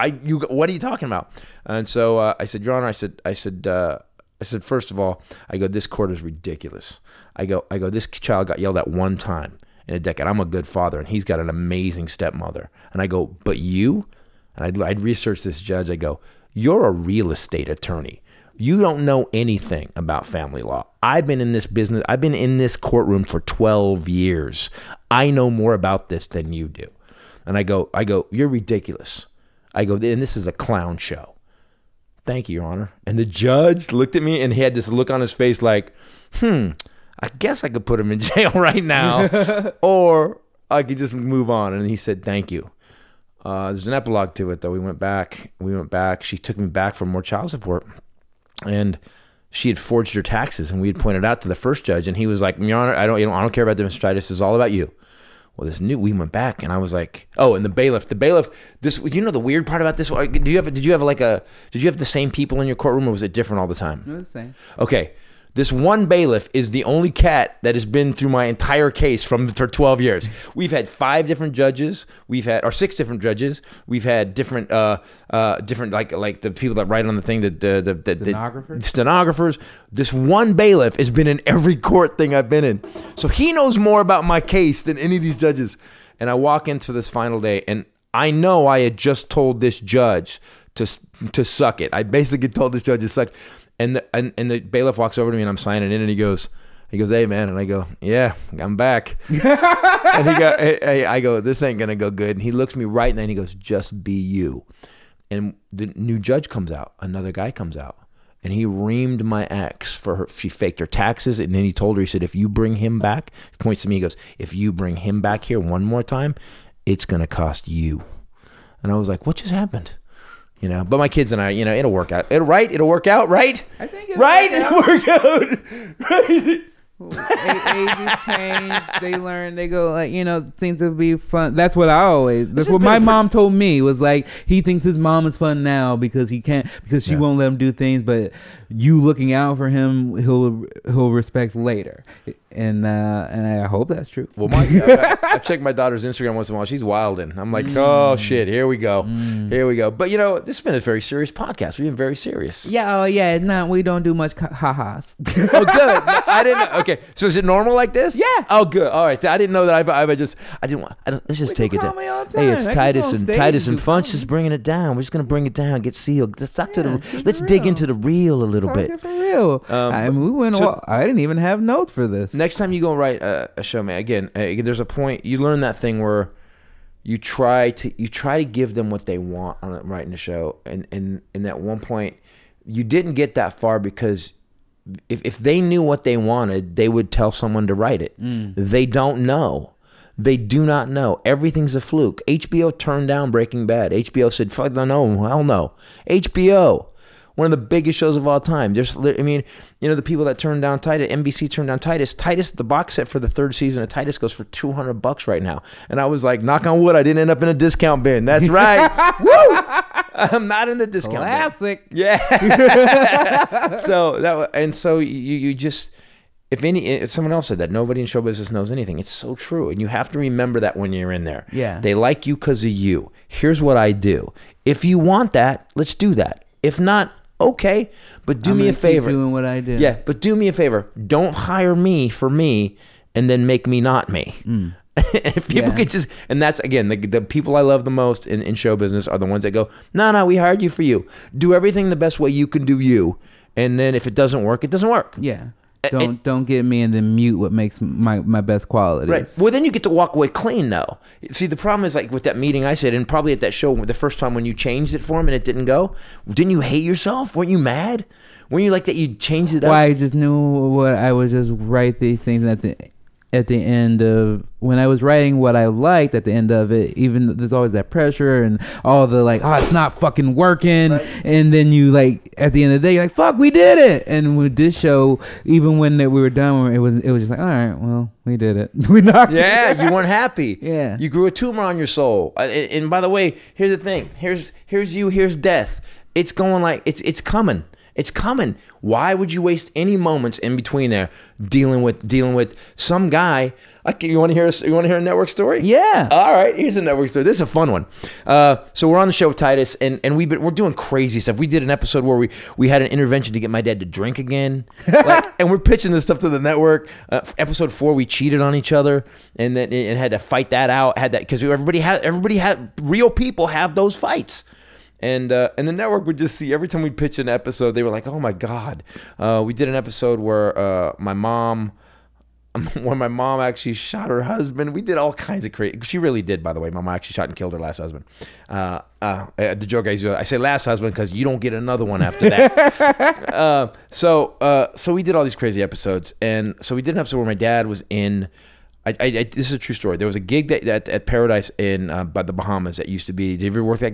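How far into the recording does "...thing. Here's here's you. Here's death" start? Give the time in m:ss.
4:43.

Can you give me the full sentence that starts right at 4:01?
Do everything the best way you can do you, and then if it doesn't work, it doesn't work.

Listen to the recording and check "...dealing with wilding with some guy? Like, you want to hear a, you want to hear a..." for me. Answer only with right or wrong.
wrong.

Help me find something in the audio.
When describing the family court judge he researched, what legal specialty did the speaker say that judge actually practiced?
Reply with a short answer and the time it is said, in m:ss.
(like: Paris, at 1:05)
real estate attorney, at 0:16.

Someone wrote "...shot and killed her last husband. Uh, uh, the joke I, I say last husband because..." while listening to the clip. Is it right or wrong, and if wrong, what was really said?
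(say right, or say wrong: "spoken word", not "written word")
right.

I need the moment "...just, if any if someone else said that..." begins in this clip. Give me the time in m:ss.
3:35.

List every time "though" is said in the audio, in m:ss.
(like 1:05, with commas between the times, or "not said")
0:44, 4:10.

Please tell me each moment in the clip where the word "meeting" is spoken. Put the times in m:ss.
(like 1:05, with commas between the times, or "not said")
4:12.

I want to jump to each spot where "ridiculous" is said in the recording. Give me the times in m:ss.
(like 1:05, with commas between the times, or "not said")
0:06, 0:28.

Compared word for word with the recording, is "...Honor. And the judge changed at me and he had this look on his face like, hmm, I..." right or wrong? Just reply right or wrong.
wrong.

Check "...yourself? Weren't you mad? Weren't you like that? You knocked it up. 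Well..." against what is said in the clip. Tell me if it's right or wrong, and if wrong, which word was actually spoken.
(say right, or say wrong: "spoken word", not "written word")
wrong: "changed", not "knocked".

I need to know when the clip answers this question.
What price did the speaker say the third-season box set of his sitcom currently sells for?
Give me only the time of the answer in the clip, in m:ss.
3:24.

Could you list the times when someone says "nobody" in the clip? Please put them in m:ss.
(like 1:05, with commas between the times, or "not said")
3:37.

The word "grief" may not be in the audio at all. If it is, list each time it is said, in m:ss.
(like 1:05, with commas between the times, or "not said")
not said.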